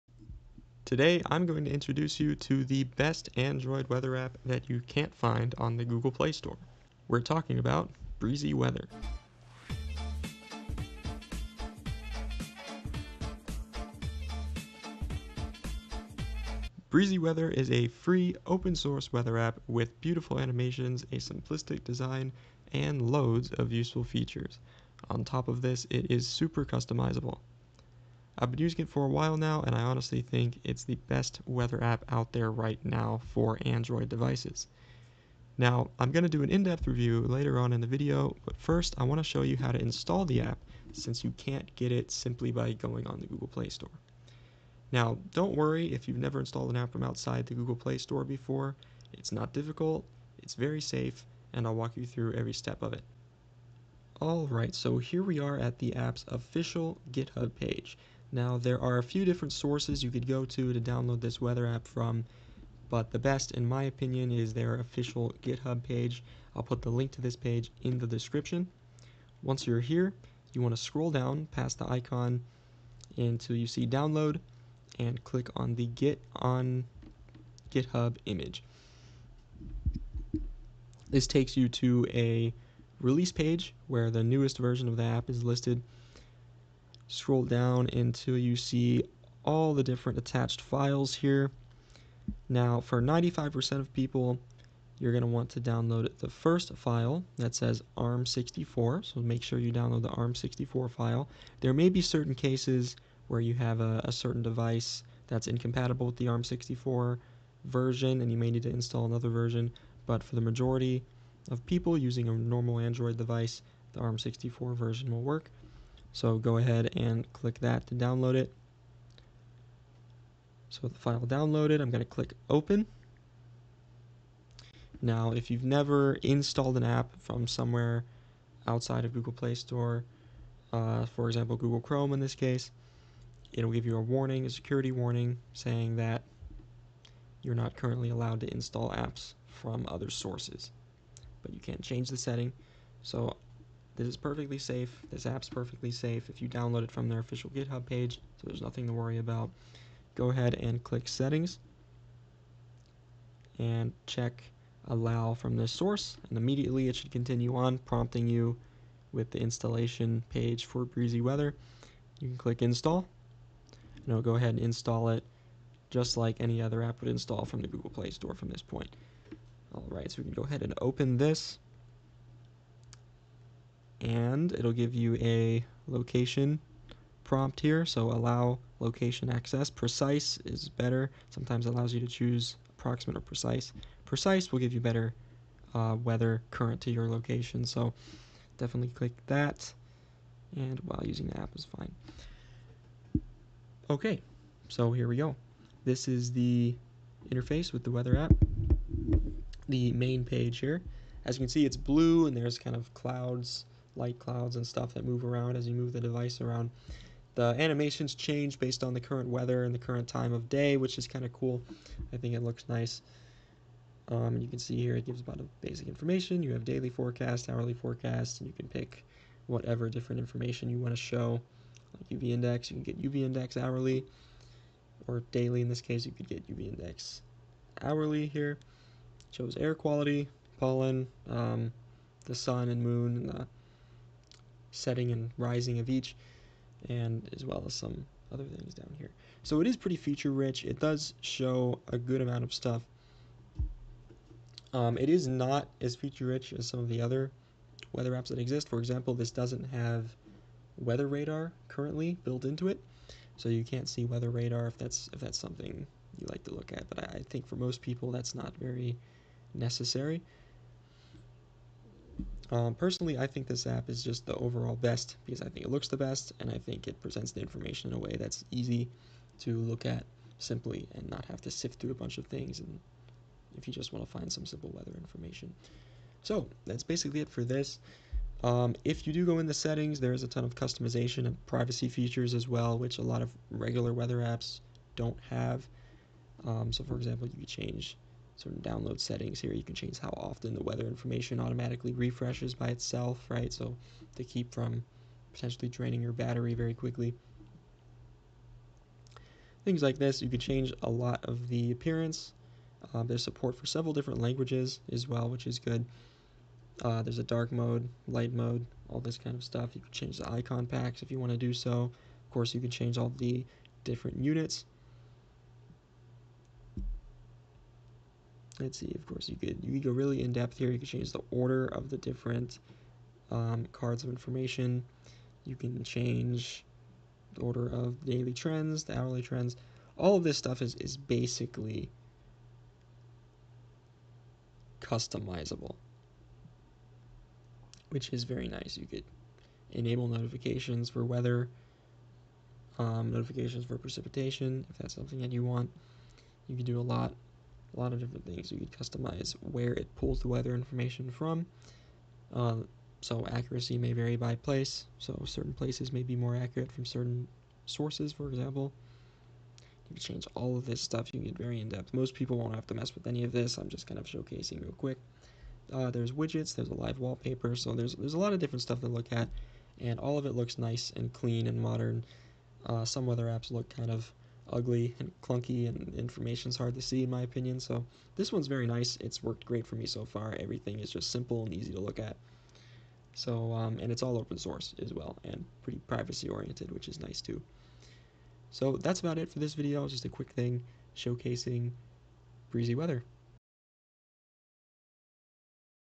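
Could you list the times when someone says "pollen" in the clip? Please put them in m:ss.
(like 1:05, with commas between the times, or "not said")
3:50.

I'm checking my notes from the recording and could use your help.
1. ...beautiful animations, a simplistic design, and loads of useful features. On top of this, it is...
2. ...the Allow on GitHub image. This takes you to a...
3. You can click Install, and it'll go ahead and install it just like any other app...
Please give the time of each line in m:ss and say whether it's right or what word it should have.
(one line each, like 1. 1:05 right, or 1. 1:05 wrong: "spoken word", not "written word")
1. 0:20 right
2. 1:15 wrong: "Git", not "Allow"
3. 2:42 right.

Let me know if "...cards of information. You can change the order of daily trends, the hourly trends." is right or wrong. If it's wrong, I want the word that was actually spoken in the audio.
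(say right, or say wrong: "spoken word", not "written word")
right.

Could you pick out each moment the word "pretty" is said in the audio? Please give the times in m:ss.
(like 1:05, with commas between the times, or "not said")
3:59, 6:25.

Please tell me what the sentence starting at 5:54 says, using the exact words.
So certain places may be more accurate from certain sources, for example.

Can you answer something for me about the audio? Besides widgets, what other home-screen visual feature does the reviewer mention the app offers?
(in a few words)
Live wallpaper.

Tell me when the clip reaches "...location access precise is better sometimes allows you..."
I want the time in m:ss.
2:58.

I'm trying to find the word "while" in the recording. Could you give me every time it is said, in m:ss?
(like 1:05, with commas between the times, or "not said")
0:29, 3:10.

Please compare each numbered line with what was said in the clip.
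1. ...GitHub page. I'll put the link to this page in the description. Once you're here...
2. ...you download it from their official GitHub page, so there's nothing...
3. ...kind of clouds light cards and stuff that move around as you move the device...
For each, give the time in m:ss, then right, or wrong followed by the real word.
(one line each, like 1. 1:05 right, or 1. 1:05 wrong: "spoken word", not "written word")
1. 1:05 right
2. 2:26 right
3. 3:22 wrong: "clouds", not "cards".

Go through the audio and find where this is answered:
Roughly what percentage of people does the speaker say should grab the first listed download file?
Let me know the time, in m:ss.
1:33.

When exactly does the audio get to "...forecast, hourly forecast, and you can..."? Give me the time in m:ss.
3:36.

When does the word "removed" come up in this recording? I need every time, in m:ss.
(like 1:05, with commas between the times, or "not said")
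not said.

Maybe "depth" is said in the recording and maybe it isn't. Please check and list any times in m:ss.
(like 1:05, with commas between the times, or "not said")
0:36, 5:20, 6:01.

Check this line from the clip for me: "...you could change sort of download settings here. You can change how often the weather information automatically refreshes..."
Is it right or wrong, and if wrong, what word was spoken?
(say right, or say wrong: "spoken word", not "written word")
right.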